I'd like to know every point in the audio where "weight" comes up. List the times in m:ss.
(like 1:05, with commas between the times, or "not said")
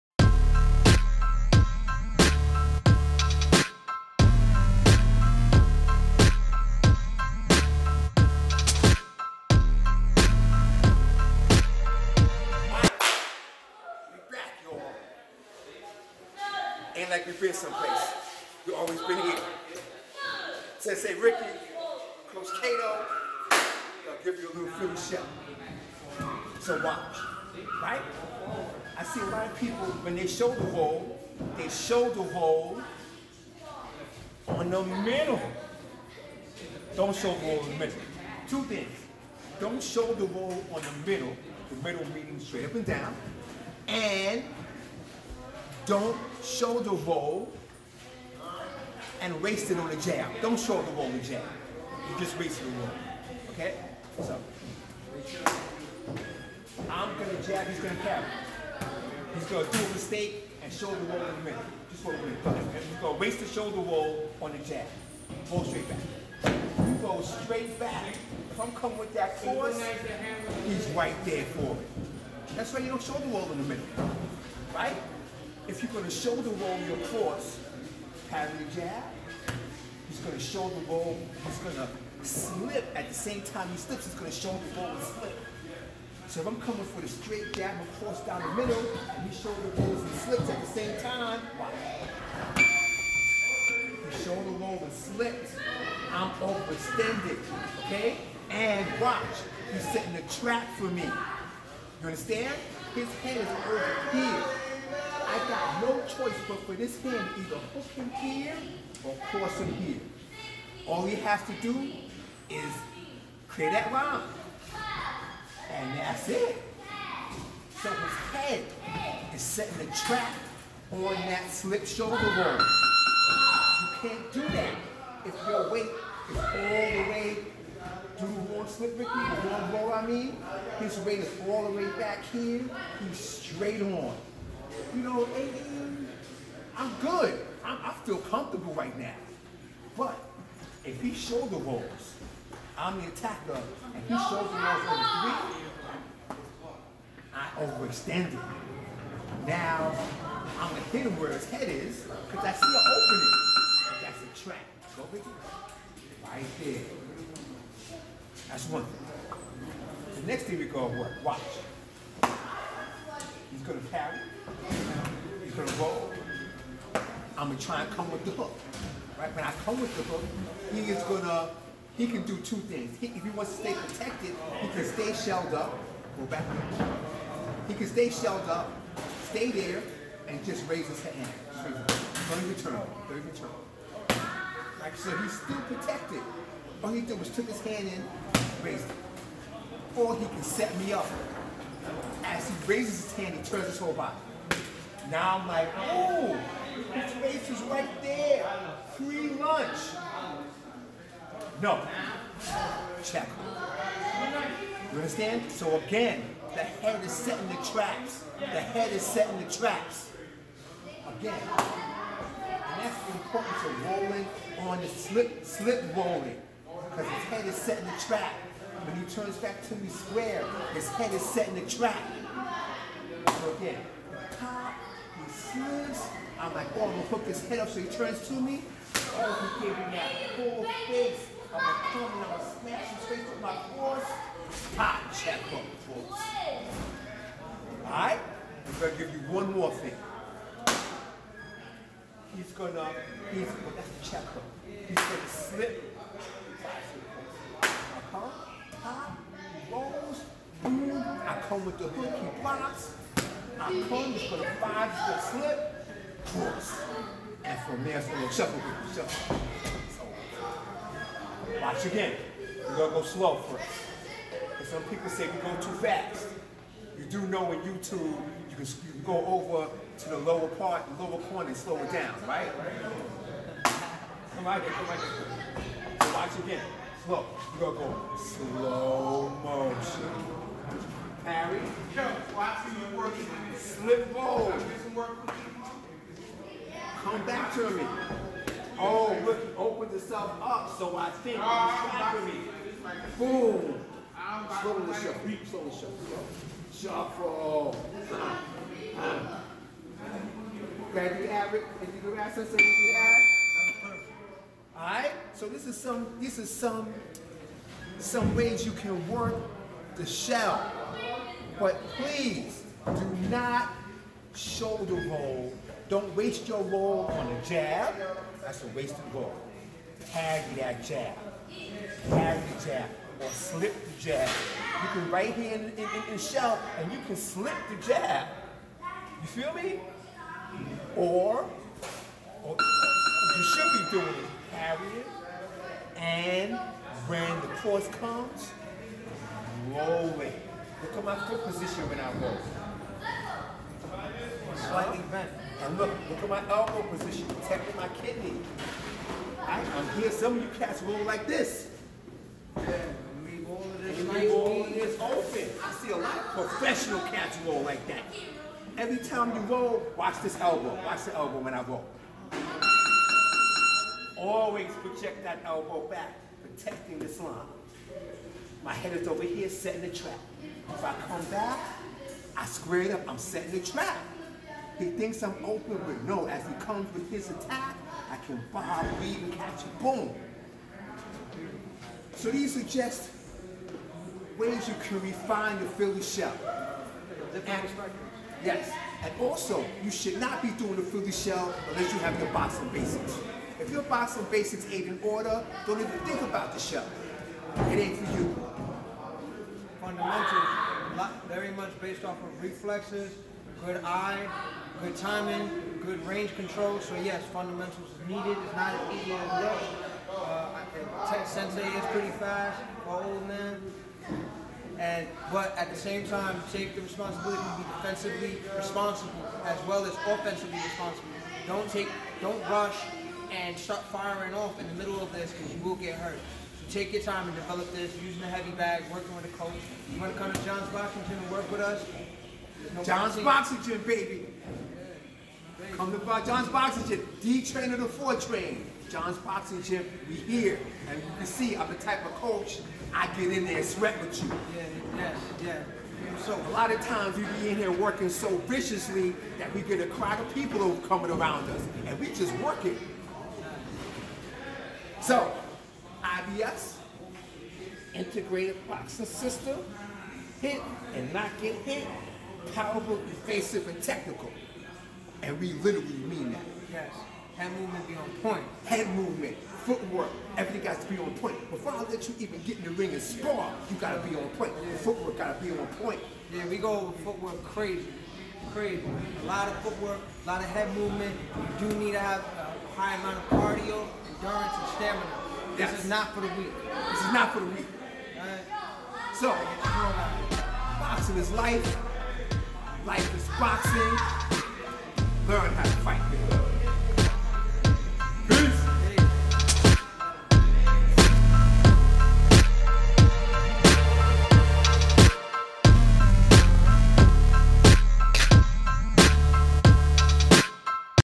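2:05, 2:10.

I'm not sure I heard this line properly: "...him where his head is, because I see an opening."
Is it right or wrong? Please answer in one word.
right.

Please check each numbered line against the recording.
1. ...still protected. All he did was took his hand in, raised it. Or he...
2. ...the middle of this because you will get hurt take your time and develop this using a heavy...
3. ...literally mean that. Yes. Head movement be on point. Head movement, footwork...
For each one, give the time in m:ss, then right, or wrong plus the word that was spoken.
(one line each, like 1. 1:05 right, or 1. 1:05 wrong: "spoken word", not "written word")
1. 3:05 right
2. 7:04 right
3. 7:45 right.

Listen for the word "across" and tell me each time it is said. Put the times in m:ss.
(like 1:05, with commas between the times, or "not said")
1:27.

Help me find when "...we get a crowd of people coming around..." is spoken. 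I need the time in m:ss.
7:29.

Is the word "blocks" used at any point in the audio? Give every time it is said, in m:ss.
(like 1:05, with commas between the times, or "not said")
4:12.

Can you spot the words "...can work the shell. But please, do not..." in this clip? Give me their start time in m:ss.
5:08.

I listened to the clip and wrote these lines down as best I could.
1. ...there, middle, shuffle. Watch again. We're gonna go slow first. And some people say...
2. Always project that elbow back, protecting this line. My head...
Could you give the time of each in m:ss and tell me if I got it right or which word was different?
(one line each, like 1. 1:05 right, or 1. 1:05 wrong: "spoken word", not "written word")
1. 4:18 wrong: "shuffle", not "middle"
2. 6:04 right.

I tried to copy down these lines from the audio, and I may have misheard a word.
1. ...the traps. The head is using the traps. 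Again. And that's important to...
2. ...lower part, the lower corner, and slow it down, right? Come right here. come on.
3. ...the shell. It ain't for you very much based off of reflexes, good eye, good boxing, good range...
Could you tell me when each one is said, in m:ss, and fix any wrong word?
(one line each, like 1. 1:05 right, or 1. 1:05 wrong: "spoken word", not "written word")
1. 3:27 wrong: "setting", not "using"
2. 4:30 right
3. 6:36 wrong: "timing", not "boxing".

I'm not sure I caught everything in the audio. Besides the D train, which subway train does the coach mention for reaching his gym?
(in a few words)
The 4 train.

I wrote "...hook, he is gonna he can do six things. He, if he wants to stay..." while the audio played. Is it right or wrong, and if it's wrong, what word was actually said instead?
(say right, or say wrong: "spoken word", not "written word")
wrong: "two", not "six".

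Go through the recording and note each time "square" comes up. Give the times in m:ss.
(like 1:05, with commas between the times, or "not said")
3:39, 6:12.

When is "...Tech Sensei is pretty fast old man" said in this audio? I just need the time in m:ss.
6:51.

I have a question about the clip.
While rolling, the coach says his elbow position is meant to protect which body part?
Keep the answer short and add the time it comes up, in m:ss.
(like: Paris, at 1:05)
Kidney, at 5:47.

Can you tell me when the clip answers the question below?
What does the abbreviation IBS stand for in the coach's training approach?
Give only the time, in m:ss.
7:37.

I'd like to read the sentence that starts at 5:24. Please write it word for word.
You can right here in, in, in, shell and you can slip the jab.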